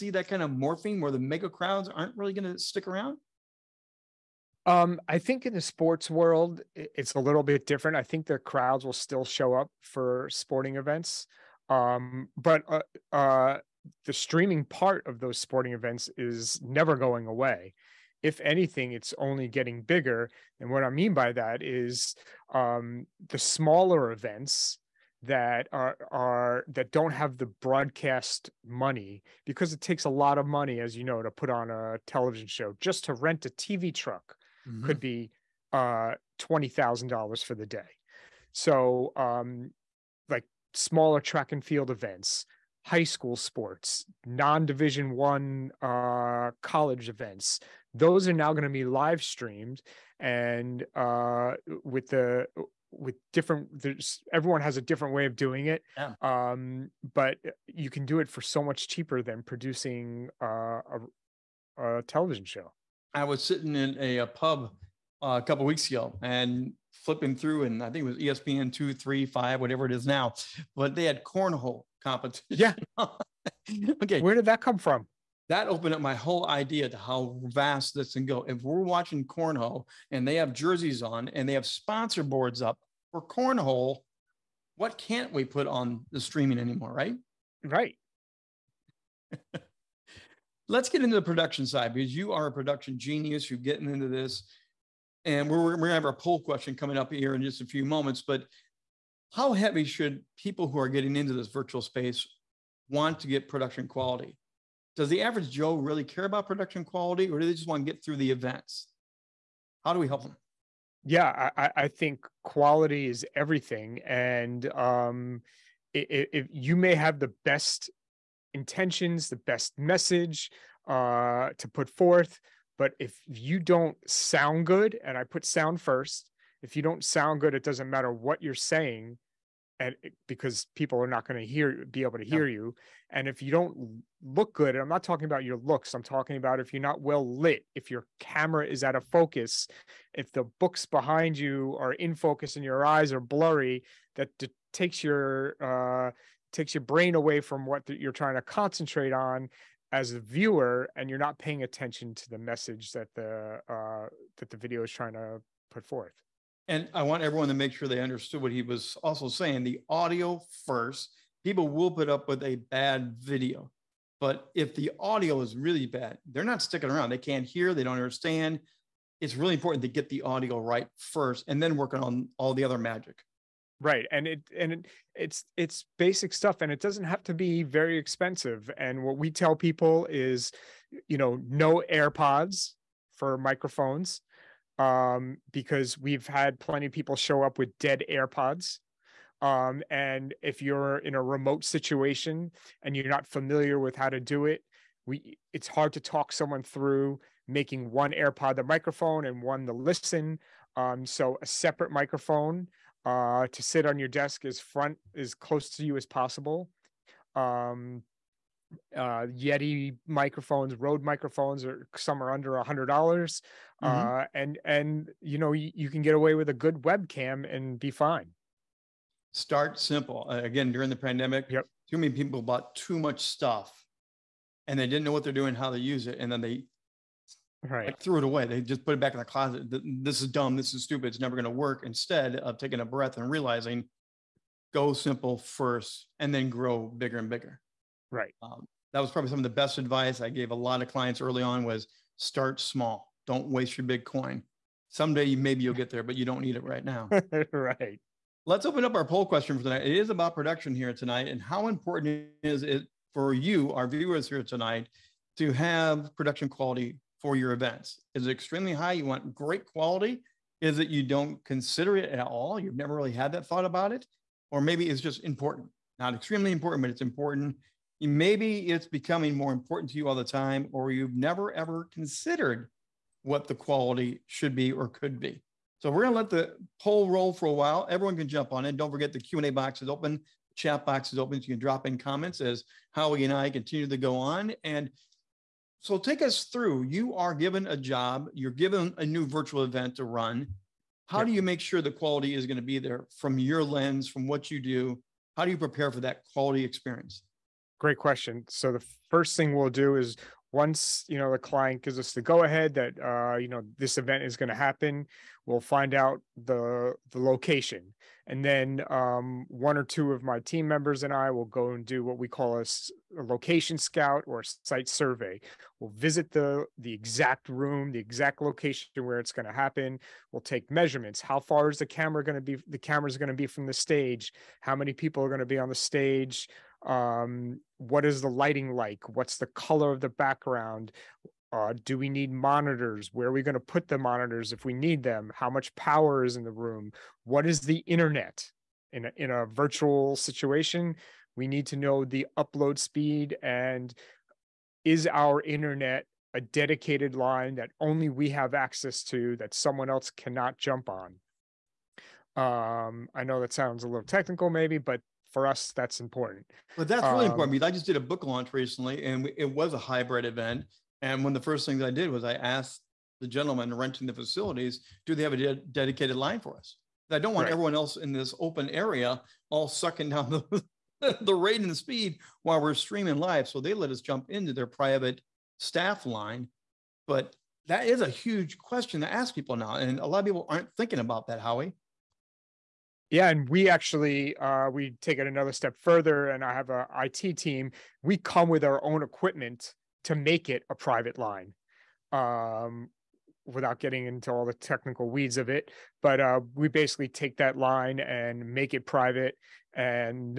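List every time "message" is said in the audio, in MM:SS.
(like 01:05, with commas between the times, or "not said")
01:59, 02:32.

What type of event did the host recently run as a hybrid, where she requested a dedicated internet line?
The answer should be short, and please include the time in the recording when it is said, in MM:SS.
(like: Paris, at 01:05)
Book launch, at 05:58.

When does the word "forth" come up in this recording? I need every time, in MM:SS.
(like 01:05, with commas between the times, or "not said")
02:01, 02:35.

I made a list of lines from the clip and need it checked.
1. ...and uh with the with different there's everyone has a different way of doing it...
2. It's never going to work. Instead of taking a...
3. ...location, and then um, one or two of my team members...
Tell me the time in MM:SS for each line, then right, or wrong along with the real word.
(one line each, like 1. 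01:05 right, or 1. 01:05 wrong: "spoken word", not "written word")
1. 00:50 right
2. 03:51 right
3. 05:07 right.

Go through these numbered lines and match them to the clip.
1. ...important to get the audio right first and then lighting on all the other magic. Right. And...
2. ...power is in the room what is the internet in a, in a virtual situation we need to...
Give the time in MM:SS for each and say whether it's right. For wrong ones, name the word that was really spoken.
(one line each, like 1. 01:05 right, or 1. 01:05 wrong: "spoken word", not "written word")
1. 02:49 wrong: "working", not "lighting"
2. 05:35 right.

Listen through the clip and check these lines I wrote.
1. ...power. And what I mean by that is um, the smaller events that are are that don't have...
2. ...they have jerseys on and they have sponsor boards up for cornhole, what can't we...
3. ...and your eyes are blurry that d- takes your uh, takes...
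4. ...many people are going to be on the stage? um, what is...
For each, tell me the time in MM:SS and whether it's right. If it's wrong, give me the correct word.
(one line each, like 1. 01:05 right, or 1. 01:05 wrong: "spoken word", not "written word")
1. 00:19 wrong: "bigger", not "power"
2. 01:20 right
3. 02:22 right
4. 05:24 right.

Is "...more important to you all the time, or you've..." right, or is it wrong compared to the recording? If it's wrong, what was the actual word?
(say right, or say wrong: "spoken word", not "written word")
right.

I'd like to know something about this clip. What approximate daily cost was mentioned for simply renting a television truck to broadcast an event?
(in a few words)
$20,000.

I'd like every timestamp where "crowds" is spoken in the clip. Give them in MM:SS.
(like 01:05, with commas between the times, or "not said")
00:01, 00:08.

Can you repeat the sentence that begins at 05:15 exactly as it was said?
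We'll visit the the exact room, the exact location where it's going to happen.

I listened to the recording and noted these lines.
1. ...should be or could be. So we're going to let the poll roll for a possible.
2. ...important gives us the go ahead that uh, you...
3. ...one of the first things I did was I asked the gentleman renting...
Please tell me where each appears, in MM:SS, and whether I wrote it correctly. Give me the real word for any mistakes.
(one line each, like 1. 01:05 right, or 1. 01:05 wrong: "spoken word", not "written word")
1. 04:34 wrong: "while", not "possible"
2. 05:01 wrong: "client", not "important"
3. 06:01 right.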